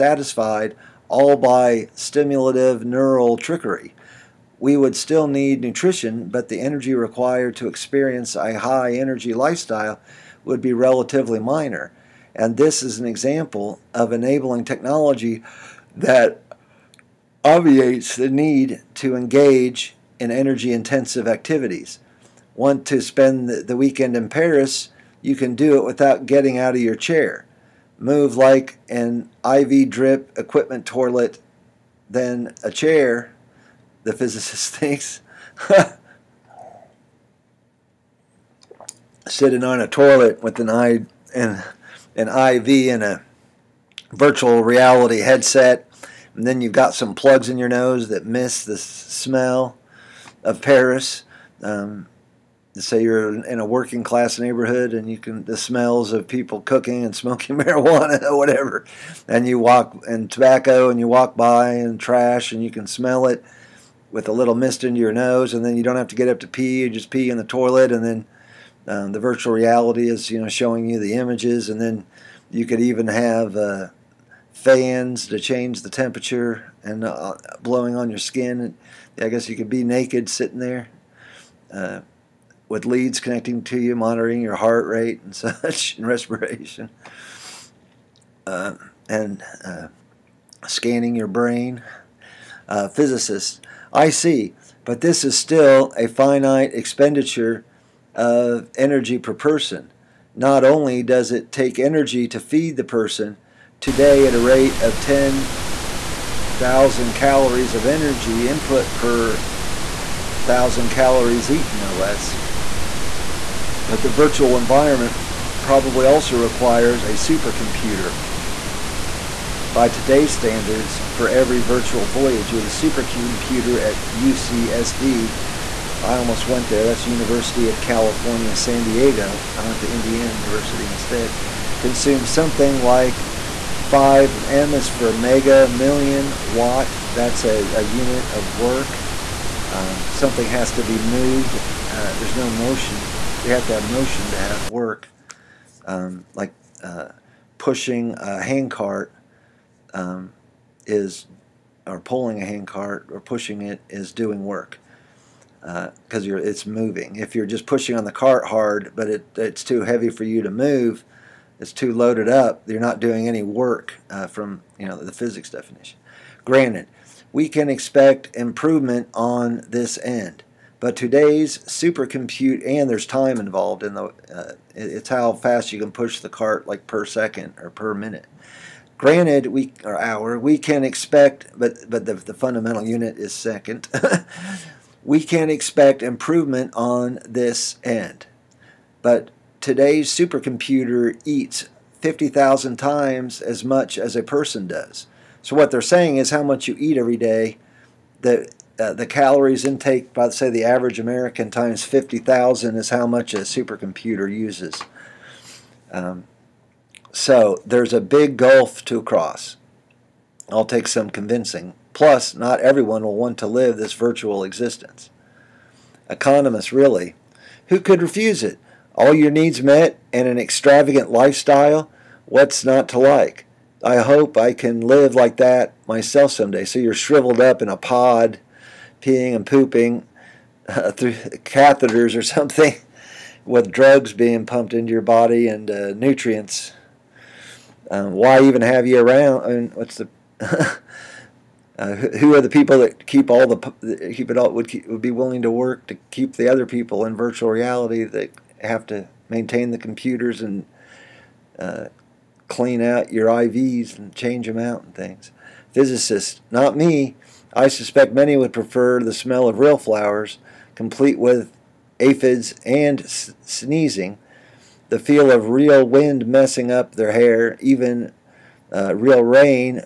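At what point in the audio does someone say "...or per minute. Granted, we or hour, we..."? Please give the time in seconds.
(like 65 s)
177 s.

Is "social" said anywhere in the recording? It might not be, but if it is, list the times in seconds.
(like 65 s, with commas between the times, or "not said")
not said.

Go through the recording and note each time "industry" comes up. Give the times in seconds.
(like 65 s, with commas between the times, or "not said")
not said.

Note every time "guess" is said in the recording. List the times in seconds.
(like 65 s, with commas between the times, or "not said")
79 s.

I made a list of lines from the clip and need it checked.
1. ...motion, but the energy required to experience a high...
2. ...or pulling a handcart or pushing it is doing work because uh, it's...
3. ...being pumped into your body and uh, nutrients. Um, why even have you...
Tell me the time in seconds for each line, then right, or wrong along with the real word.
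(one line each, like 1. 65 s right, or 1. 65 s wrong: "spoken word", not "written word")
1. 5 s wrong: "nutrition", not "motion"
2. 151 s right
3. 234 s right.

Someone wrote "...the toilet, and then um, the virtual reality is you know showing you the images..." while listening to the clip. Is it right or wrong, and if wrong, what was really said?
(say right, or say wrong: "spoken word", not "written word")
right.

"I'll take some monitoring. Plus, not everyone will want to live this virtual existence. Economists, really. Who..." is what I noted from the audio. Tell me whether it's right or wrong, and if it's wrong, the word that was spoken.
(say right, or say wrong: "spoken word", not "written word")
wrong: "convincing", not "monitoring".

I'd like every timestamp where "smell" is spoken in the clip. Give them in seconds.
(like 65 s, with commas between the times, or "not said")
48 s, 55 s, 62 s, 259 s.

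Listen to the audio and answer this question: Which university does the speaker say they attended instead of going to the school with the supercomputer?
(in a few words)
Indiana University.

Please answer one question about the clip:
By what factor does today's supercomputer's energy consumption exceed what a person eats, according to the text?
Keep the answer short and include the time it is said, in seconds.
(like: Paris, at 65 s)
50,000, at 192 s.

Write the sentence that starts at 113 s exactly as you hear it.
But the virtual environment probably also requires a supercomputer.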